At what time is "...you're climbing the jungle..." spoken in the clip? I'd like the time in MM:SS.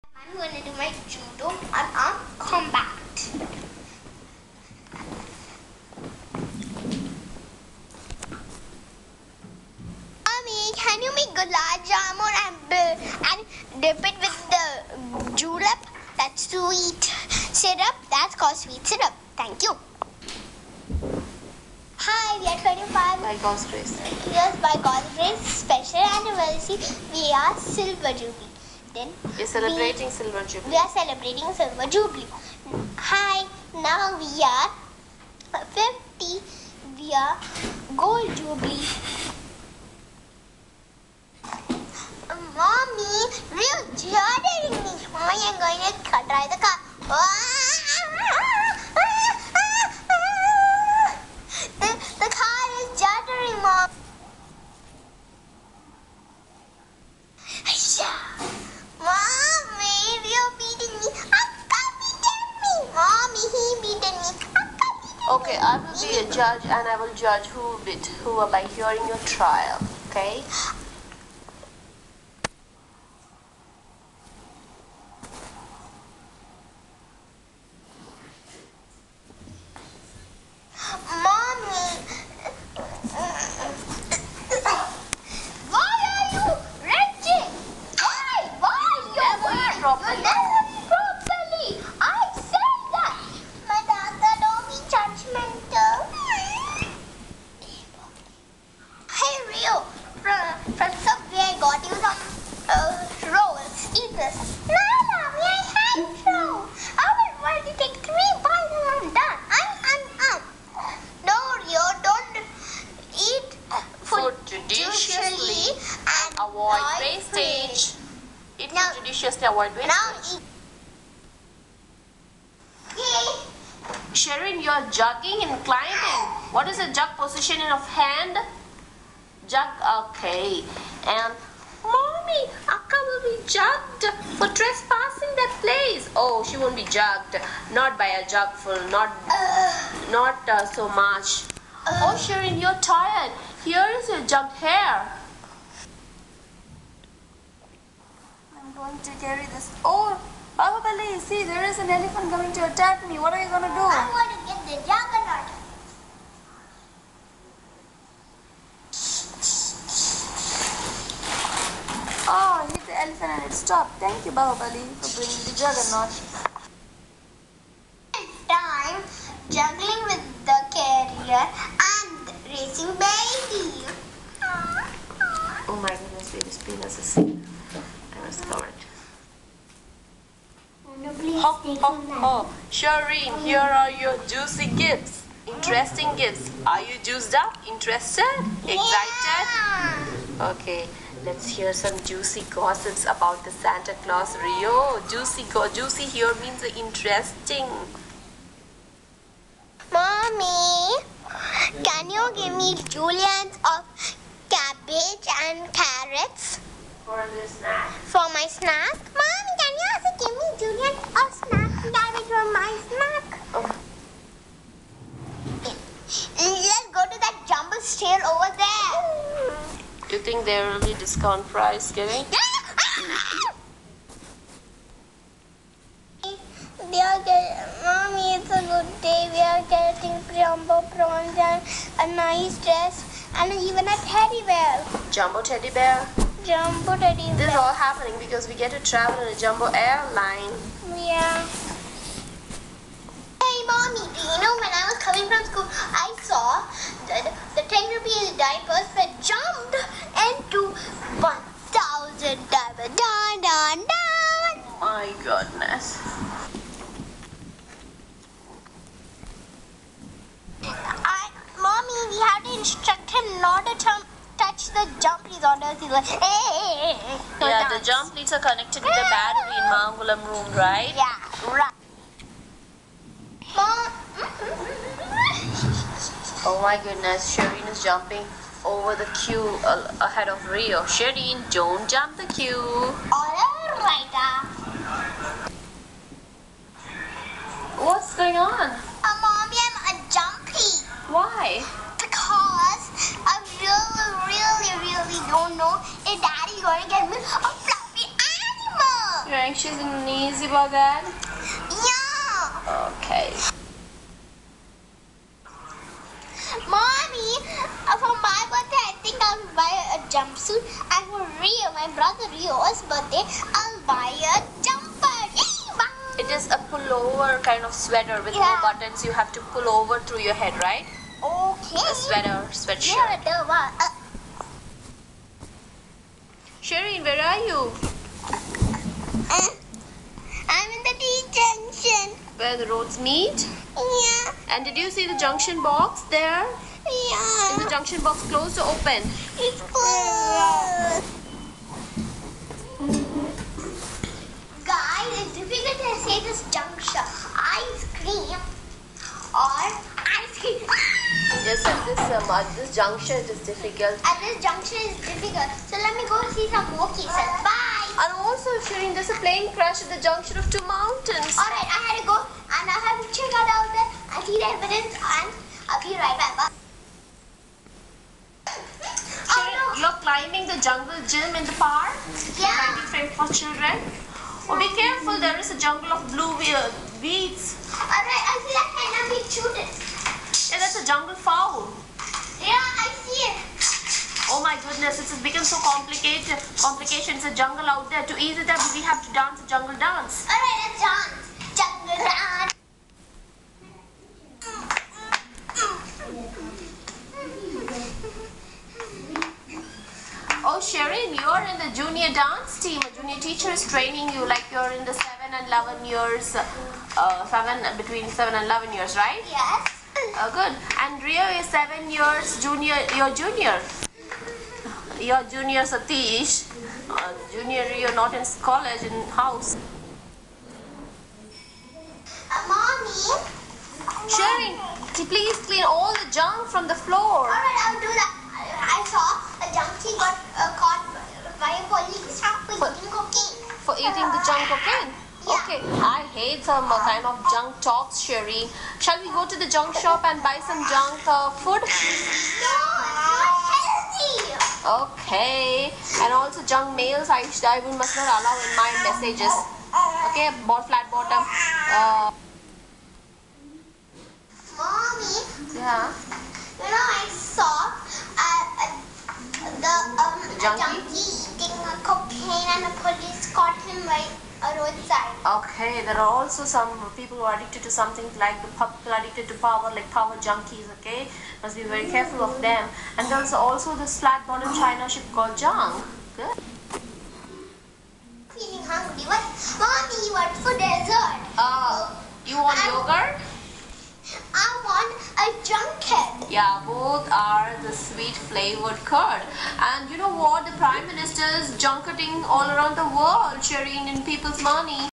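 06:09.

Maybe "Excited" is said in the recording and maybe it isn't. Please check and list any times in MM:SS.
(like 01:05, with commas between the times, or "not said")
03:08.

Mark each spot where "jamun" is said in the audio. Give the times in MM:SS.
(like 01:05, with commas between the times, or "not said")
00:11.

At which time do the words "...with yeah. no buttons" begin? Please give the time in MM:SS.
05:18.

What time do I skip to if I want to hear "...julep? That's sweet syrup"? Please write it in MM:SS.
00:15.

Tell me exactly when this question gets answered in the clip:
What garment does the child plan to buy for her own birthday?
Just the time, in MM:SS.
05:10.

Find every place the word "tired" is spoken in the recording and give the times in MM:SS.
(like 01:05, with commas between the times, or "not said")
02:22.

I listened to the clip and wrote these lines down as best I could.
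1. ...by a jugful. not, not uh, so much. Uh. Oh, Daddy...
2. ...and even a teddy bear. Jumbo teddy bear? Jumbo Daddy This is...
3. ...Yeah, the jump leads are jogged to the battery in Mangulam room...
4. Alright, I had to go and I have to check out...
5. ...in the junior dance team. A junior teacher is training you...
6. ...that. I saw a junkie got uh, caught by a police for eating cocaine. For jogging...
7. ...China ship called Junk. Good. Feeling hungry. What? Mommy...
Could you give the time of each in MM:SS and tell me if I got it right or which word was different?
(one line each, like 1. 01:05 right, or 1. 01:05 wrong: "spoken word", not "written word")
1. 02:17 wrong: "Sharon", not "Daddy"
2. 03:53 right
3. 04:27 wrong: "connected", not "jogged"
4. 06:01 right
5. 06:41 right
6. 07:07 wrong: "eating", not "jogging"
7. 07:54 right.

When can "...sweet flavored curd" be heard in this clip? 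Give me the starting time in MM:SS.
08:07.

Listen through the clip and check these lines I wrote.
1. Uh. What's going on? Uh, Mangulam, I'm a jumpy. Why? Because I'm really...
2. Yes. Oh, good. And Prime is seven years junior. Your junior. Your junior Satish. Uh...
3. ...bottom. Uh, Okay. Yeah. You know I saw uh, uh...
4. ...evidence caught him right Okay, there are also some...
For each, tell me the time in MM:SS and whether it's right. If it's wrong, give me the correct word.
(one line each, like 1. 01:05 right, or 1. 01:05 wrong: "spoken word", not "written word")
1. 04:44 wrong: "Mommy", not "Mangulam"
2. 06:49 wrong: "Rio", not "Prime"
3. 07:30 wrong: "Mommy", not "Okay"
4. 07:42 wrong: "police", not "evidence".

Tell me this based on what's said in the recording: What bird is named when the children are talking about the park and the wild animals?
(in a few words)
Jungle fowl.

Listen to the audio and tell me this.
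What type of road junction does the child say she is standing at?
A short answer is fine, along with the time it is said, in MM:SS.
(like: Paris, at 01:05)
T junction, at 05:30.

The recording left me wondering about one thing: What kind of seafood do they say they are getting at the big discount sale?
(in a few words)
Jumbo prawns.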